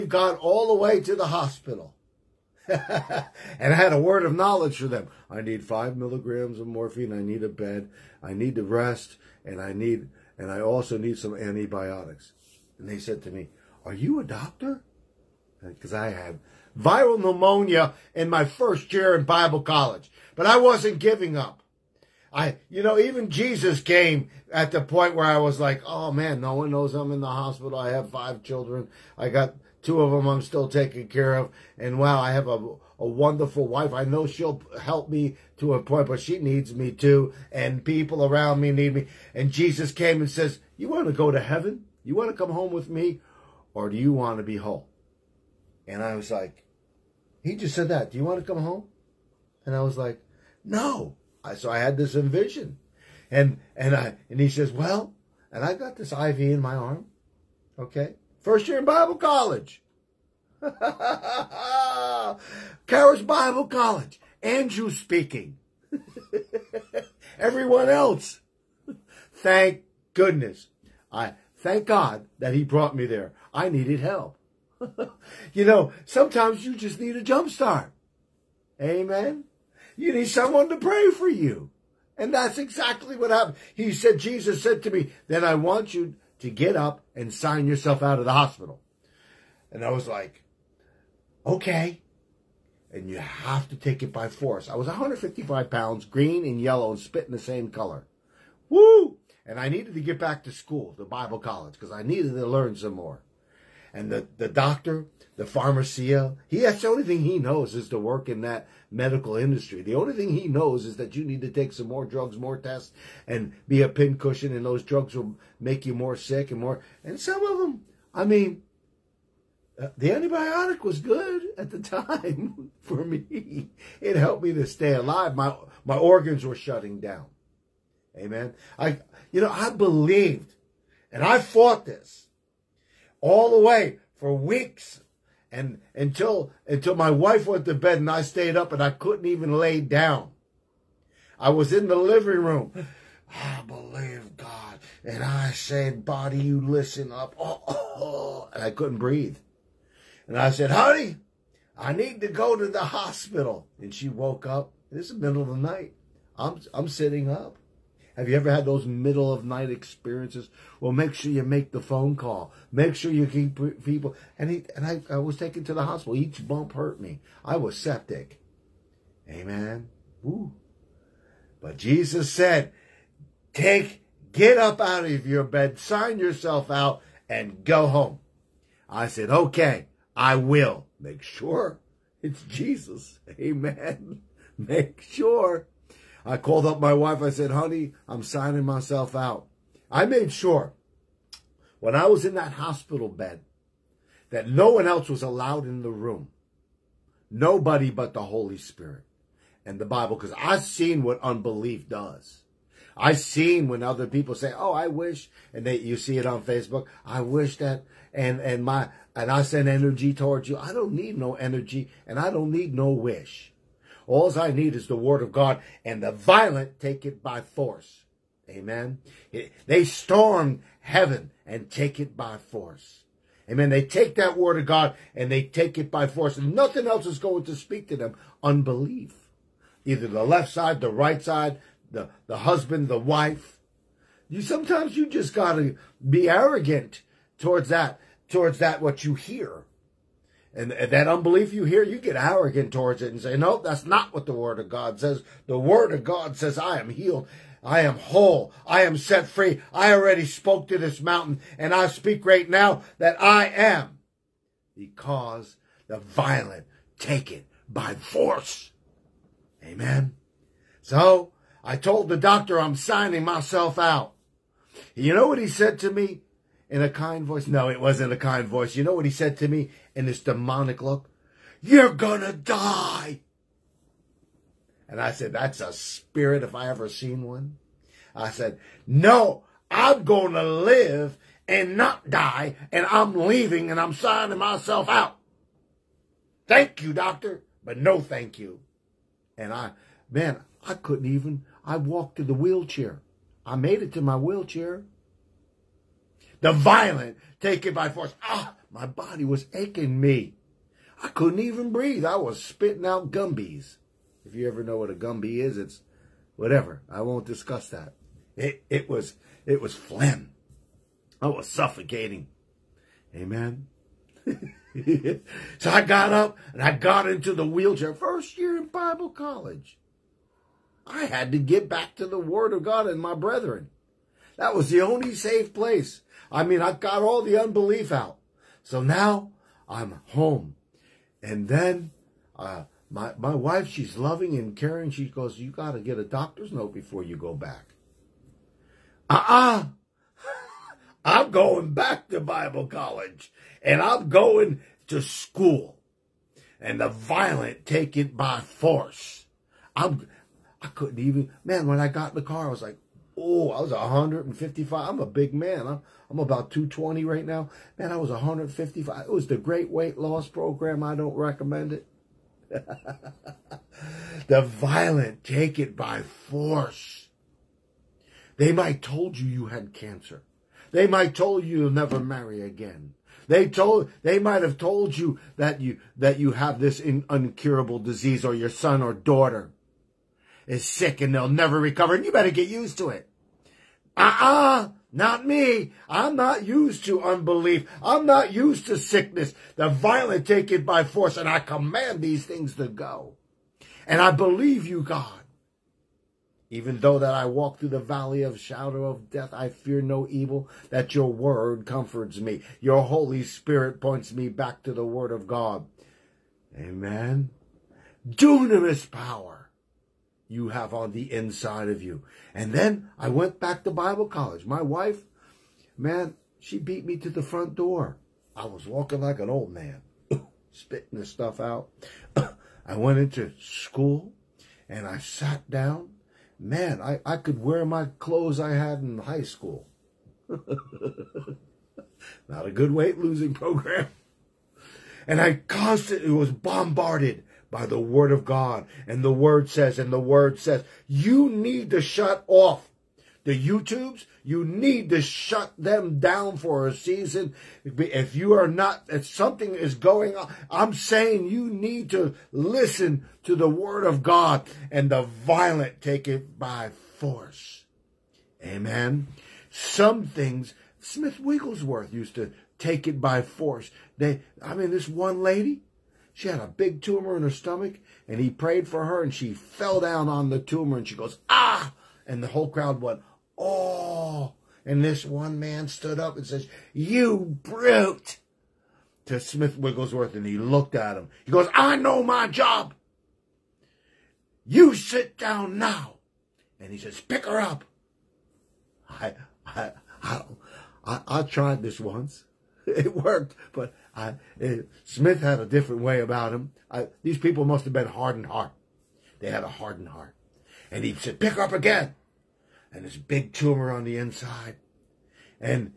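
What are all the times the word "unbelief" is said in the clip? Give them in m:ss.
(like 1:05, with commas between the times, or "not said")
3:21, 3:48, 4:01, 5:27, 6:27.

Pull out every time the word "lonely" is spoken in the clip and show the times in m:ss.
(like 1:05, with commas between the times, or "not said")
not said.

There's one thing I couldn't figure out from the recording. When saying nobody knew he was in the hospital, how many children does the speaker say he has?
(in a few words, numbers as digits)
5.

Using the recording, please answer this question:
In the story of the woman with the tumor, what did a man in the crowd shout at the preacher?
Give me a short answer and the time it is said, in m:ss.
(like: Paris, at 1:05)
You brute, at 7:56.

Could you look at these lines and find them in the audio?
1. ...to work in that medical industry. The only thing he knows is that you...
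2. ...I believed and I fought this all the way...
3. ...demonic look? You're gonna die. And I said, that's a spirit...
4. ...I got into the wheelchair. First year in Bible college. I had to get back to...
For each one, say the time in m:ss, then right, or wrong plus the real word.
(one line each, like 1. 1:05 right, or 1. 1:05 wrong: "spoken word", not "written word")
1. 1:47 right
2. 2:09 right
3. 4:30 right
4. 5:16 right.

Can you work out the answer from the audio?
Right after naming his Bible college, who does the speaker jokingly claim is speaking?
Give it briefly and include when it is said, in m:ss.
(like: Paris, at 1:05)
Andrew, at 1:04.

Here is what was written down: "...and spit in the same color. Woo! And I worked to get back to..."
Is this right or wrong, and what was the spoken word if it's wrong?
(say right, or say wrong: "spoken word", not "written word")
wrong: "needed", not "worked".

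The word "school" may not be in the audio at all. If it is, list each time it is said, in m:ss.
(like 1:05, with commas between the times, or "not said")
1:40, 5:45, 7:03, 7:09.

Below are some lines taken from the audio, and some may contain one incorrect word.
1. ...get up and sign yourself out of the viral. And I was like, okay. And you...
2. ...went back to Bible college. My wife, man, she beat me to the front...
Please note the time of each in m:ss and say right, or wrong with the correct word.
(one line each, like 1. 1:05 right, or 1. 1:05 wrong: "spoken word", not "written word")
1. 1:26 wrong: "hospital", not "viral"
2. 6:53 right.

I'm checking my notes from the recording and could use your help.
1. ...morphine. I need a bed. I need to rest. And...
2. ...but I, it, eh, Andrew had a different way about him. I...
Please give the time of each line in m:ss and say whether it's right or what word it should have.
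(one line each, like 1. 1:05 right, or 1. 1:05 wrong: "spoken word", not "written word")
1. 0:06 right
2. 8:13 wrong: "Smith", not "Andrew".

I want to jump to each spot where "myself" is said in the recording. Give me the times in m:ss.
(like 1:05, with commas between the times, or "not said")
3:08, 4:23, 4:44.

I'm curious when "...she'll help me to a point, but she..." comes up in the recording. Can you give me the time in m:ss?
0:34.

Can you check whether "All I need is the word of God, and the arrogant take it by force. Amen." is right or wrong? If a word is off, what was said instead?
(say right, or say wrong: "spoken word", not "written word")
wrong: "violent", not "arrogant".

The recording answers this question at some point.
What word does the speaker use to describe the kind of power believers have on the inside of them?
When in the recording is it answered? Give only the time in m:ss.
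6:48.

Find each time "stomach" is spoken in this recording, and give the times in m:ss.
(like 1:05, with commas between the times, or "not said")
7:47.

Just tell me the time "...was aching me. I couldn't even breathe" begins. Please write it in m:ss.
4:59.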